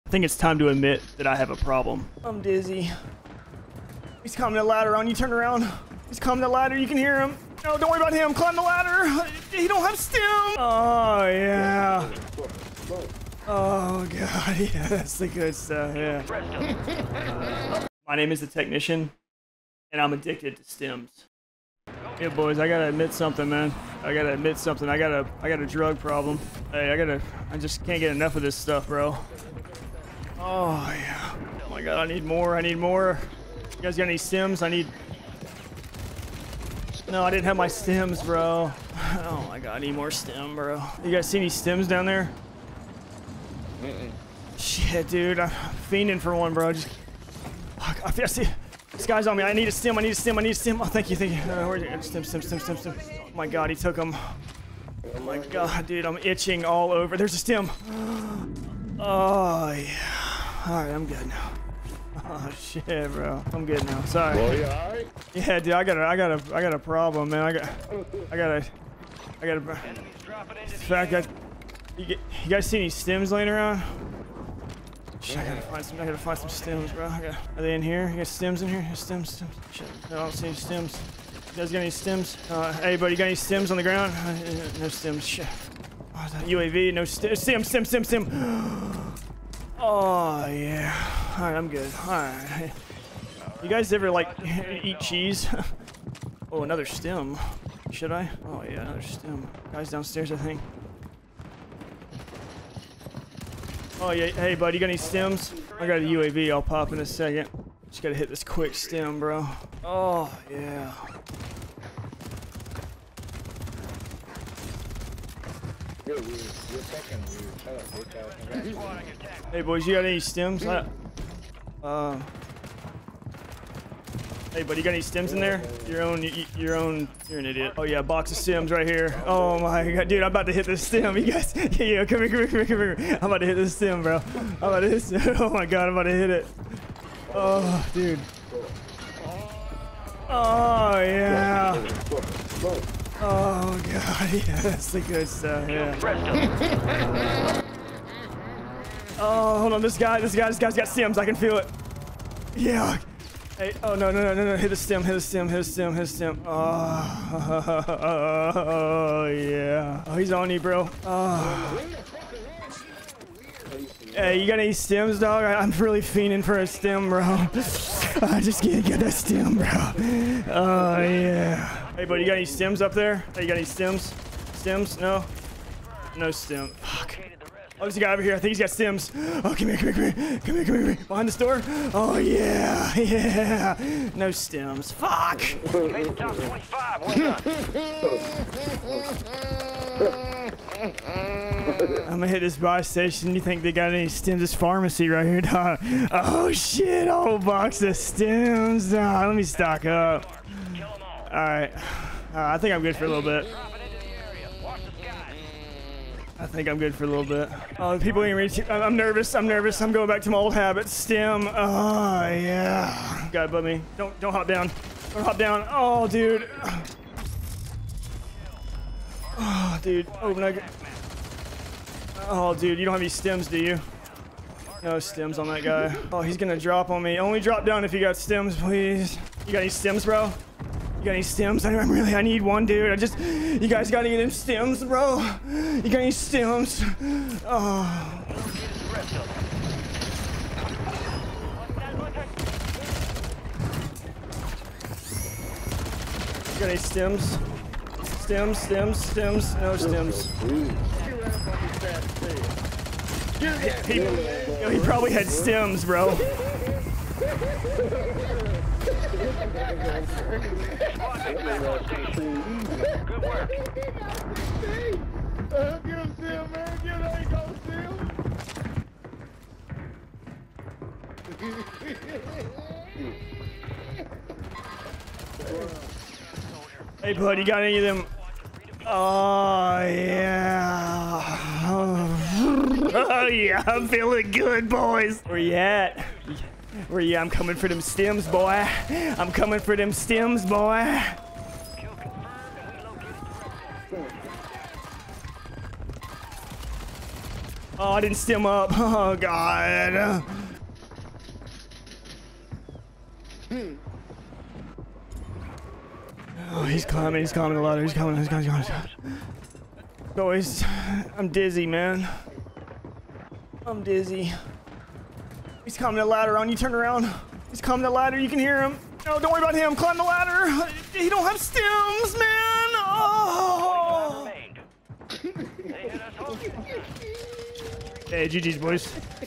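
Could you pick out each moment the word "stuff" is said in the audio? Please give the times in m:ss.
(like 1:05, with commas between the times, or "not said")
0:15, 0:28, 2:25.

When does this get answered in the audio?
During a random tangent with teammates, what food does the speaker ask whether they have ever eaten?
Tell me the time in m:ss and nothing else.
1:34.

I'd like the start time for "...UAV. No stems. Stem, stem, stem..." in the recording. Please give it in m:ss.
1:26.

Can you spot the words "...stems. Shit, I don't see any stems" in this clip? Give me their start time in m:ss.
1:19.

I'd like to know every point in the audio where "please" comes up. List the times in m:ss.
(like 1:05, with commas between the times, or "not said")
3:48.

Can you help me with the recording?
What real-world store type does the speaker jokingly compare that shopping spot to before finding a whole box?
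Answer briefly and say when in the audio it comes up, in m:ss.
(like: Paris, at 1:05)
pharmacy, at 3:14.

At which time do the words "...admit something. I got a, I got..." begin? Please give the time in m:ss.
0:24.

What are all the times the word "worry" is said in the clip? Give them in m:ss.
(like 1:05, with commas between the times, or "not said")
0:07, 5:19.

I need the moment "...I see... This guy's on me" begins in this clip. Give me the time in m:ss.
0:48.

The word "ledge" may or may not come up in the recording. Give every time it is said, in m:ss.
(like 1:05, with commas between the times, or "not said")
not said.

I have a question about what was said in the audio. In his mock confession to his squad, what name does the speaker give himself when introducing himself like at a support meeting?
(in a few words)
The Technician.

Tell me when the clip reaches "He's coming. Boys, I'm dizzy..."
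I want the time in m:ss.
5:08.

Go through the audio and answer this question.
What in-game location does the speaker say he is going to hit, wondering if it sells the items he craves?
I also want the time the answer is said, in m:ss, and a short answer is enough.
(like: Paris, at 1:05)
buy station, at 3:12.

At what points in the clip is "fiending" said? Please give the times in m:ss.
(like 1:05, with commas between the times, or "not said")
0:45, 2:46.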